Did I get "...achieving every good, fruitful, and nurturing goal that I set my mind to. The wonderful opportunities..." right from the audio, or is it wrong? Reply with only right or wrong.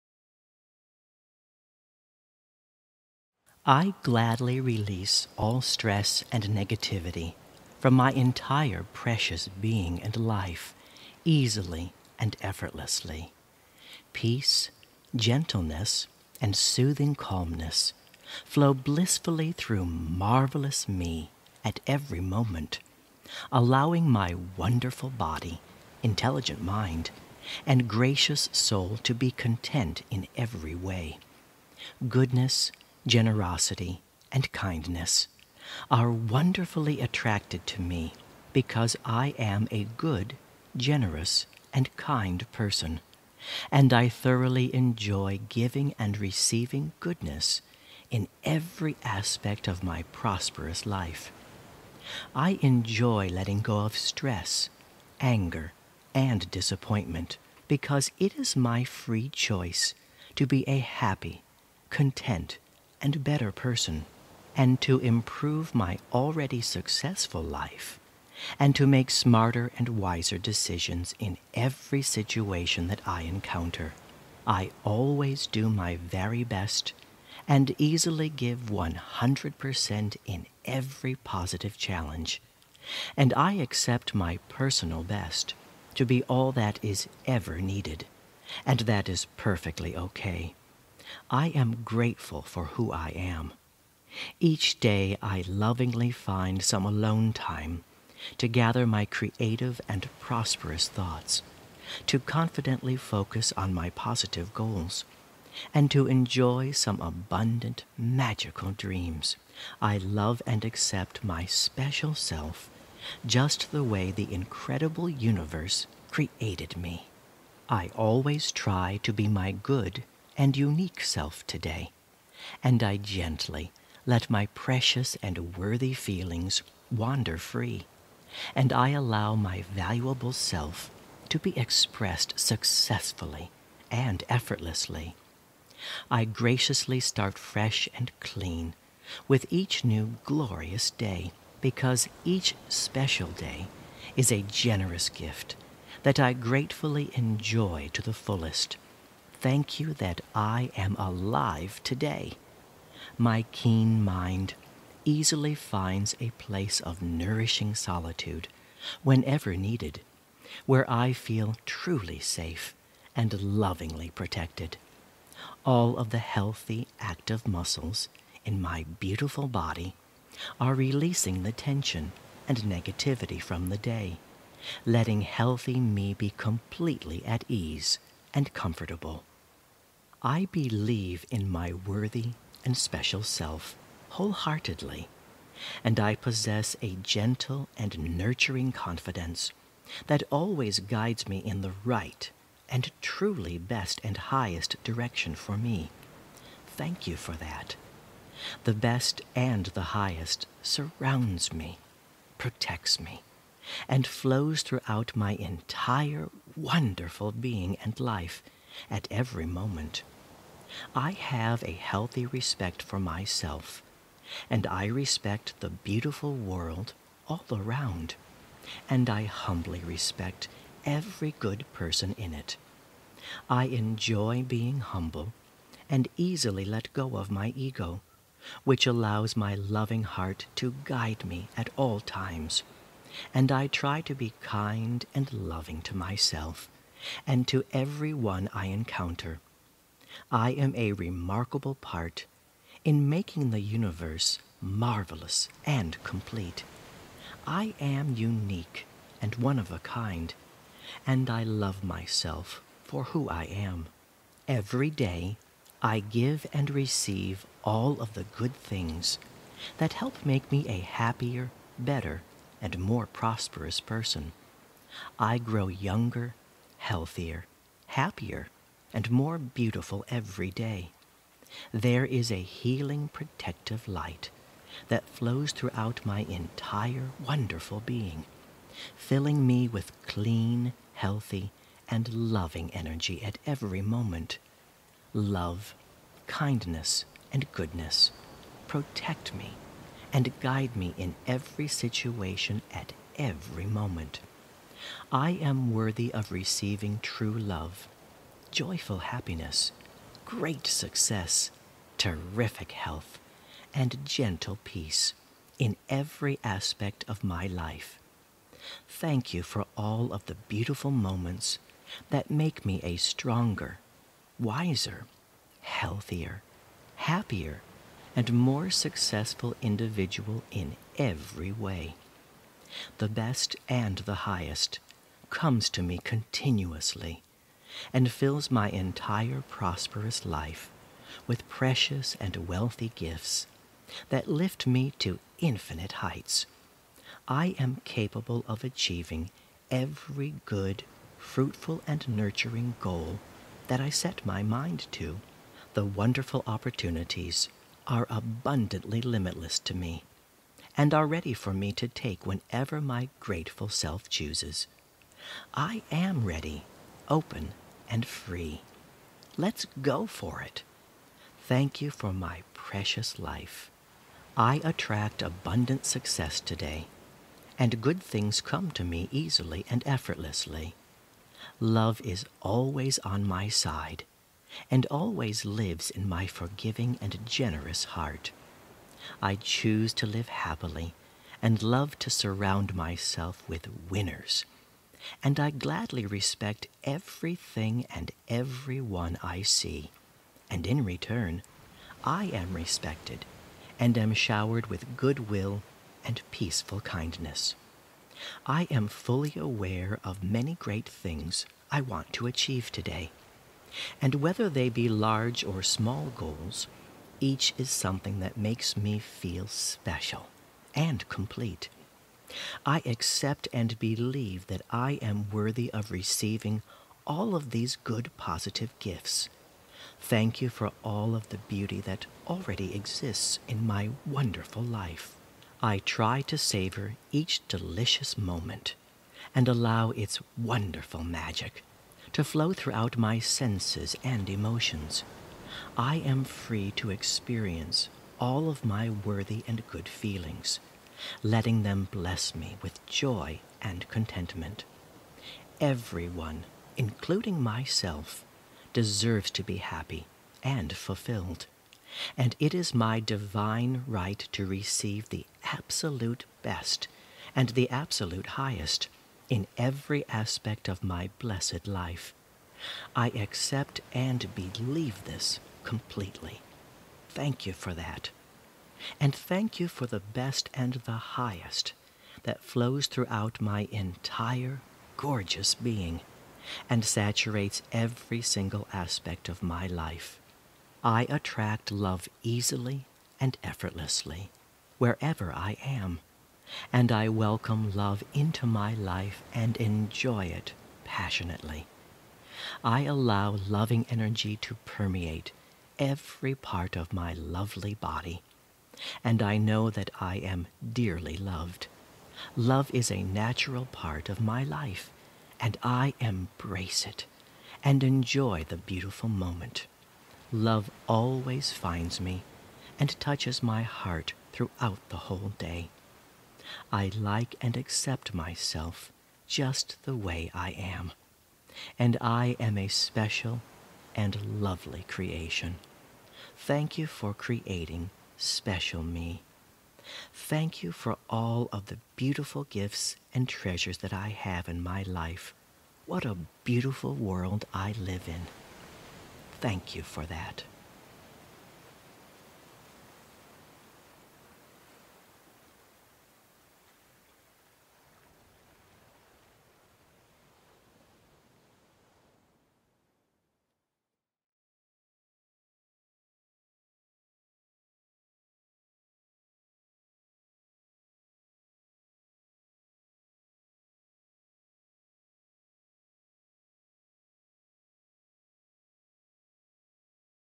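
right.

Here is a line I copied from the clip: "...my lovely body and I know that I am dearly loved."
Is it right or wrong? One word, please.
right.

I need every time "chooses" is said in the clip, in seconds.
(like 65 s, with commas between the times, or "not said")
354 s, 379 s.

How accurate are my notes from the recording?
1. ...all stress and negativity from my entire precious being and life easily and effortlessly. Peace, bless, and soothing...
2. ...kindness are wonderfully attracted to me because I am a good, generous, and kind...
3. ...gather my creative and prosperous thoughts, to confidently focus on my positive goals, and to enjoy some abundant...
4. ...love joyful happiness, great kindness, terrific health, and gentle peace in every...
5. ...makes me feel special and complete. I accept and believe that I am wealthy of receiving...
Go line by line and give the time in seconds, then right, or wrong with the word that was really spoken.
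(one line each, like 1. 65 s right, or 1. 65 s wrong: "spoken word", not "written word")
1. 5 s wrong: "gentleness", not "bless"
2. 34 s right
3. 98 s right
4. 297 s wrong: "success", not "kindness"
5. 408 s wrong: "worthy", not "wealthy".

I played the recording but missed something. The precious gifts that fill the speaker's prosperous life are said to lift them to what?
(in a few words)
infinite heights.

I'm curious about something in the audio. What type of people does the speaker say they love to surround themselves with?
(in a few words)
winners.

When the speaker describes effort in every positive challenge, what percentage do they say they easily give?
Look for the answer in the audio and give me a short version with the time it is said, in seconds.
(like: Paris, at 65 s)
100%, at 78 s.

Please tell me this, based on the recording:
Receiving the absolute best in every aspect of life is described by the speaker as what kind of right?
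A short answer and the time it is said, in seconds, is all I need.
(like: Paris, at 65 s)
divine right, at 452 s.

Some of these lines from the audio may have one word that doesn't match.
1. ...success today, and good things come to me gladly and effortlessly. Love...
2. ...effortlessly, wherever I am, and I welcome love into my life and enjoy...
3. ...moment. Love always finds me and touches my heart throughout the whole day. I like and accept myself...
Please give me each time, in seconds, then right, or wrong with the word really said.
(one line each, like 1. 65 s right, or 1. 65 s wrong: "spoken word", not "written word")
1. 365 s wrong: "easily", not "gladly"
2. 483 s right
3. 509 s right.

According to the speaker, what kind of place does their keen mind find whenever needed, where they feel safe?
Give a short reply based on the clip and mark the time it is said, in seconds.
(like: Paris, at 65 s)
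nourishing solitude, at 157 s.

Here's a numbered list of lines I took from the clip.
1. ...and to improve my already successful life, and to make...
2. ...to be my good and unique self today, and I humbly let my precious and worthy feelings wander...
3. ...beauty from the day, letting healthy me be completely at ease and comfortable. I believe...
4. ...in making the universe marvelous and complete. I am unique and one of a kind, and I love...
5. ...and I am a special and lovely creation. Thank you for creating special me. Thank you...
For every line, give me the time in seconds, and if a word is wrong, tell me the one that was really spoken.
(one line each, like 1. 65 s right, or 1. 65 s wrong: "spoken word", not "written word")
1. 64 s right
2. 119 s wrong: "gently", not "humbly"
3. 172 s wrong: "negativity", not "beauty"
4. 242 s right
5. 521 s right.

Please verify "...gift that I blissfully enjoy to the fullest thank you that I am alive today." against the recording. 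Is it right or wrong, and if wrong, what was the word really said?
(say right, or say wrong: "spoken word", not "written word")
wrong: "gratefully", not "blissfully".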